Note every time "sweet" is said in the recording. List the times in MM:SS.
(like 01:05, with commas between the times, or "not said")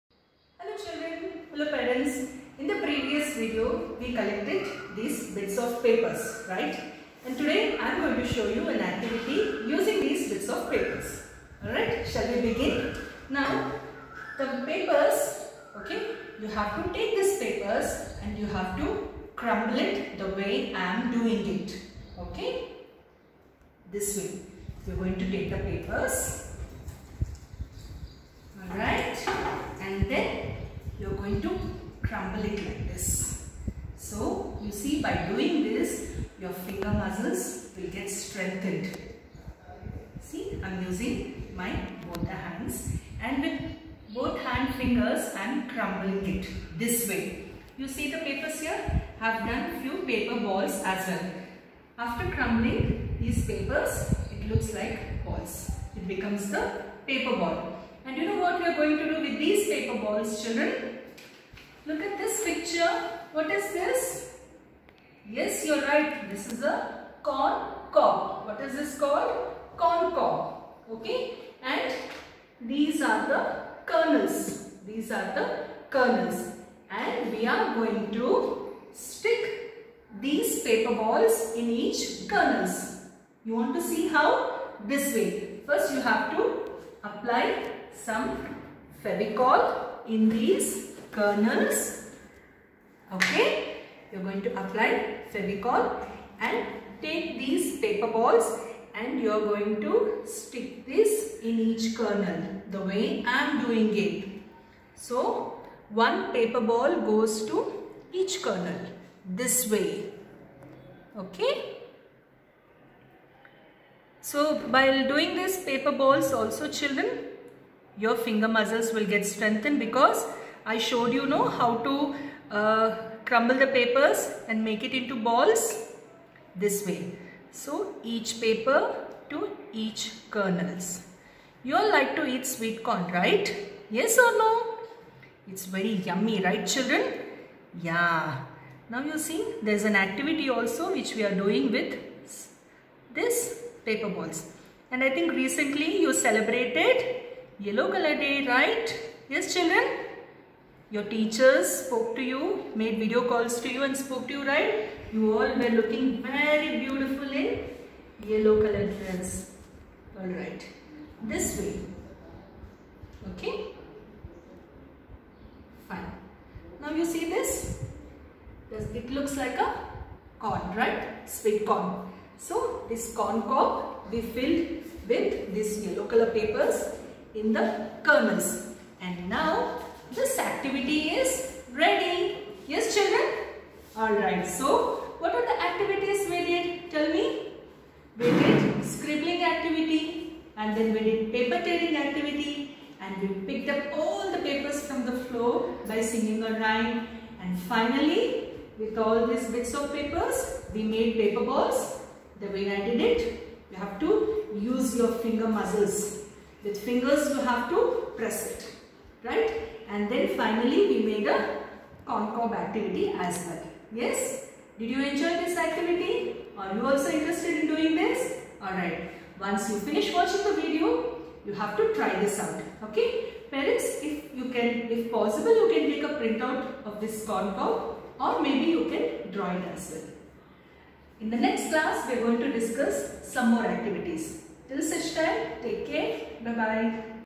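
02:12, 02:51.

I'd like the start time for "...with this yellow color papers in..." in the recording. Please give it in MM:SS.
02:55.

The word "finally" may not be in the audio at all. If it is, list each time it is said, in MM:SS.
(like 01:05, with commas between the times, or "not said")
03:17, 03:30.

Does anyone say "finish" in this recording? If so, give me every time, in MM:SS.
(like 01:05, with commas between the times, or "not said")
03:39.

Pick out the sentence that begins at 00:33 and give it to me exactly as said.
So you see by doing this your finger muscles will get strengthened.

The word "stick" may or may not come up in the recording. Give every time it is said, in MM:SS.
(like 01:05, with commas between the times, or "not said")
01:18, 01:40.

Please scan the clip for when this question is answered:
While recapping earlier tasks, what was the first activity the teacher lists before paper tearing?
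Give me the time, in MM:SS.
03:08.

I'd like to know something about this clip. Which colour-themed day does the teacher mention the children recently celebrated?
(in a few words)
Yellow color day.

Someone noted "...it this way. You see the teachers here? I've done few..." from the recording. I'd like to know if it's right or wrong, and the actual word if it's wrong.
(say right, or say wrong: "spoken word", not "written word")
wrong: "papers", not "teachers".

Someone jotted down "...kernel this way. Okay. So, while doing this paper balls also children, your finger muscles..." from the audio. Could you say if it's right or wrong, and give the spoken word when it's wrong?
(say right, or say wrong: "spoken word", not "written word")
right.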